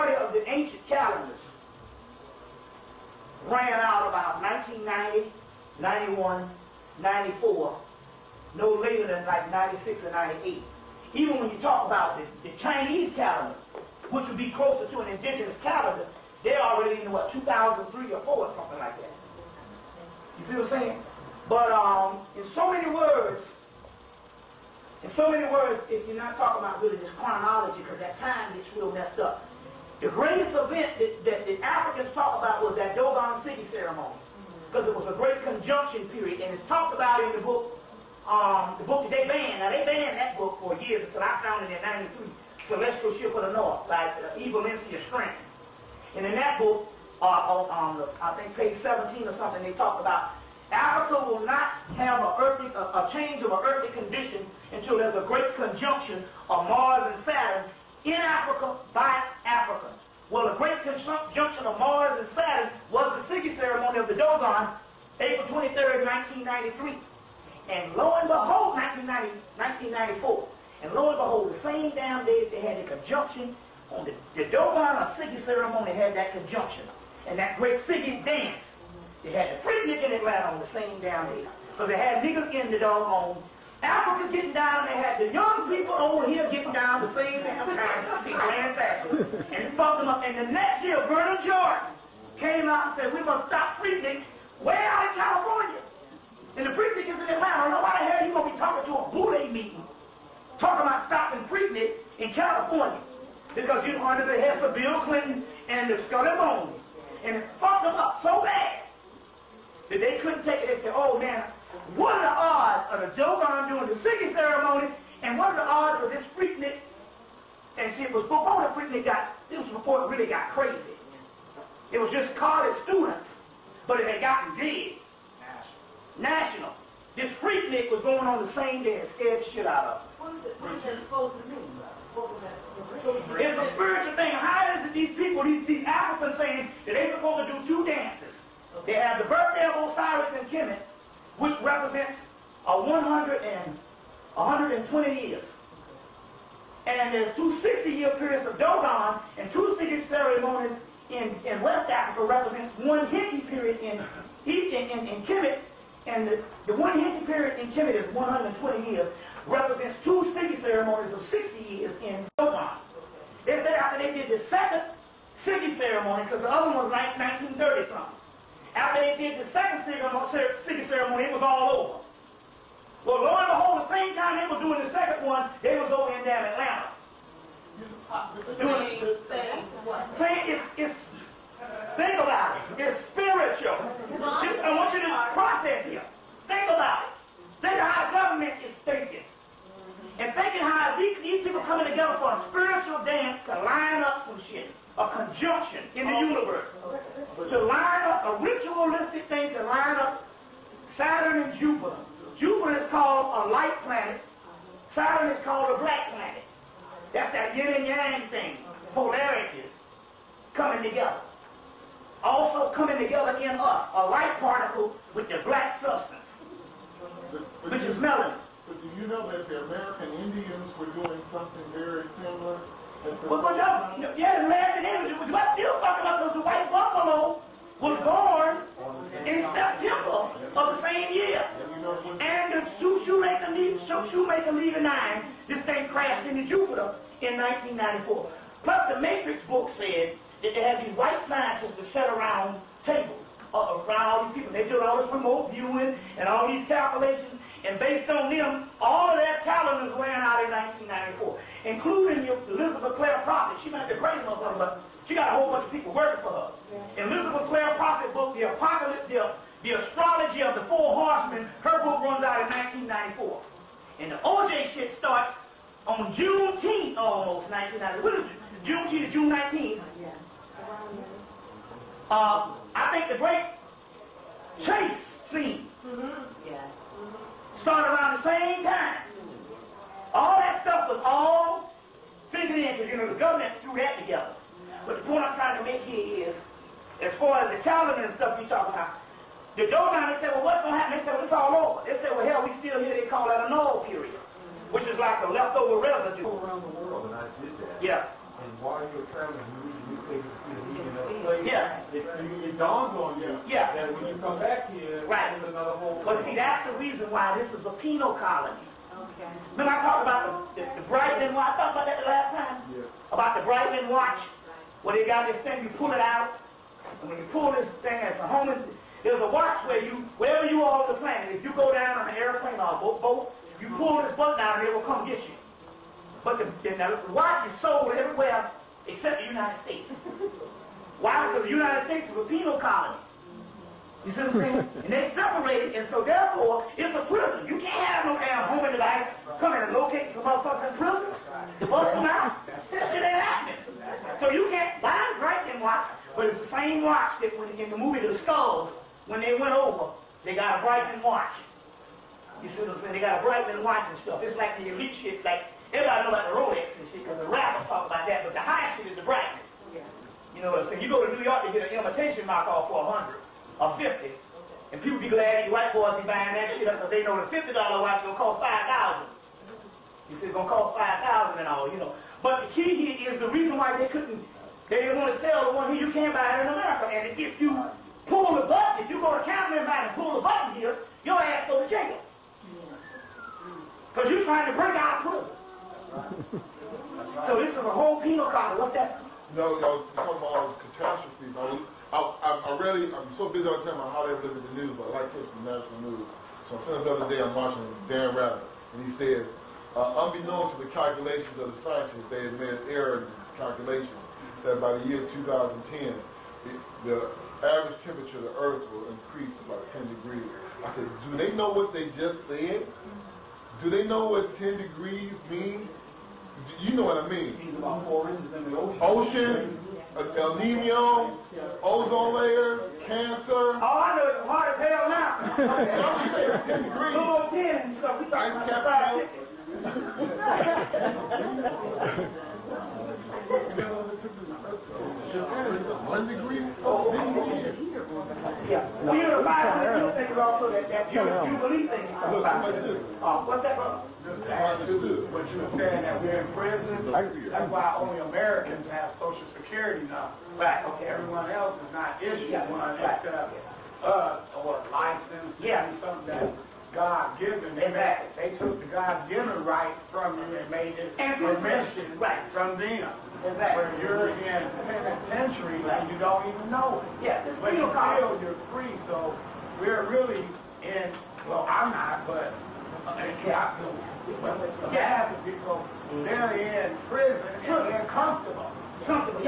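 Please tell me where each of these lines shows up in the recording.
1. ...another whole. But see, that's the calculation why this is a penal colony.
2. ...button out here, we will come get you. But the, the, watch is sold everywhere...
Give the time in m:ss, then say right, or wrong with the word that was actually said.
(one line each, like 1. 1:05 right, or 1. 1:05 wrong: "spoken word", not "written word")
1. 5:05 wrong: "reason", not "calculation"
2. 5:24 right.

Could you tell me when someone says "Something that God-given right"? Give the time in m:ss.
7:35.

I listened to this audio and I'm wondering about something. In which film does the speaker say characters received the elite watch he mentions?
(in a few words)
The Skulls.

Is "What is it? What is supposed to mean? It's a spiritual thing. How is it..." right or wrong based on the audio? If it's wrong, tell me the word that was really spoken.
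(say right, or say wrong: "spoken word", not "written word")
right.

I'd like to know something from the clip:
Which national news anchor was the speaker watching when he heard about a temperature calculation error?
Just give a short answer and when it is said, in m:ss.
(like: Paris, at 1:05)
Dan Rather, at 6:37.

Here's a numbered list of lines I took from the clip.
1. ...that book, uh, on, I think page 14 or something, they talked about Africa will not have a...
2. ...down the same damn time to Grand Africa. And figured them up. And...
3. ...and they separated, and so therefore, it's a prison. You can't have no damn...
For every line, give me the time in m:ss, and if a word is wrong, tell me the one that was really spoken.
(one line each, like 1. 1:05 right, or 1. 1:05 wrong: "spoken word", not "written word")
1. 0:46 wrong: "17", not "14"
2. 1:26 wrong: "fucked", not "figured"
3. 5:34 right.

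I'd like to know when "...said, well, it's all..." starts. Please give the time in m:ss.
4:51.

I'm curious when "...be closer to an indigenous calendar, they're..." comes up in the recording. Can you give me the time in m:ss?
0:14.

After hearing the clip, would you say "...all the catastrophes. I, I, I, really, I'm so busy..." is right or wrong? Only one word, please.
right.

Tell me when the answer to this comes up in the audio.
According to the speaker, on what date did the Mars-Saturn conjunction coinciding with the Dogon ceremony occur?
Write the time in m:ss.
1:05.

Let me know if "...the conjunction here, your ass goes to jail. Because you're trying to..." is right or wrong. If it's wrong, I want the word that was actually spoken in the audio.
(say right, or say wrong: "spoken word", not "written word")
wrong: "button", not "conjunction".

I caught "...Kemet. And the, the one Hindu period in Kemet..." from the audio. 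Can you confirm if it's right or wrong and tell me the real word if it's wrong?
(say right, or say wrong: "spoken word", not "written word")
right.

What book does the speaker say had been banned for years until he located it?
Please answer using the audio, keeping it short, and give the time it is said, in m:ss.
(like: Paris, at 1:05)
Celestial Ship of the North, at 0:42.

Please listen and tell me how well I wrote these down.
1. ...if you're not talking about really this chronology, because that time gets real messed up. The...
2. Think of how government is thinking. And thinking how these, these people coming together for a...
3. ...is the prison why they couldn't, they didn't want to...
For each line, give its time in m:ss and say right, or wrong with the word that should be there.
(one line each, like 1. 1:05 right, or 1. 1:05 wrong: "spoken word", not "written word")
1. 0:25 right
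2. 3:07 right
3. 6:13 wrong: "reason", not "prison".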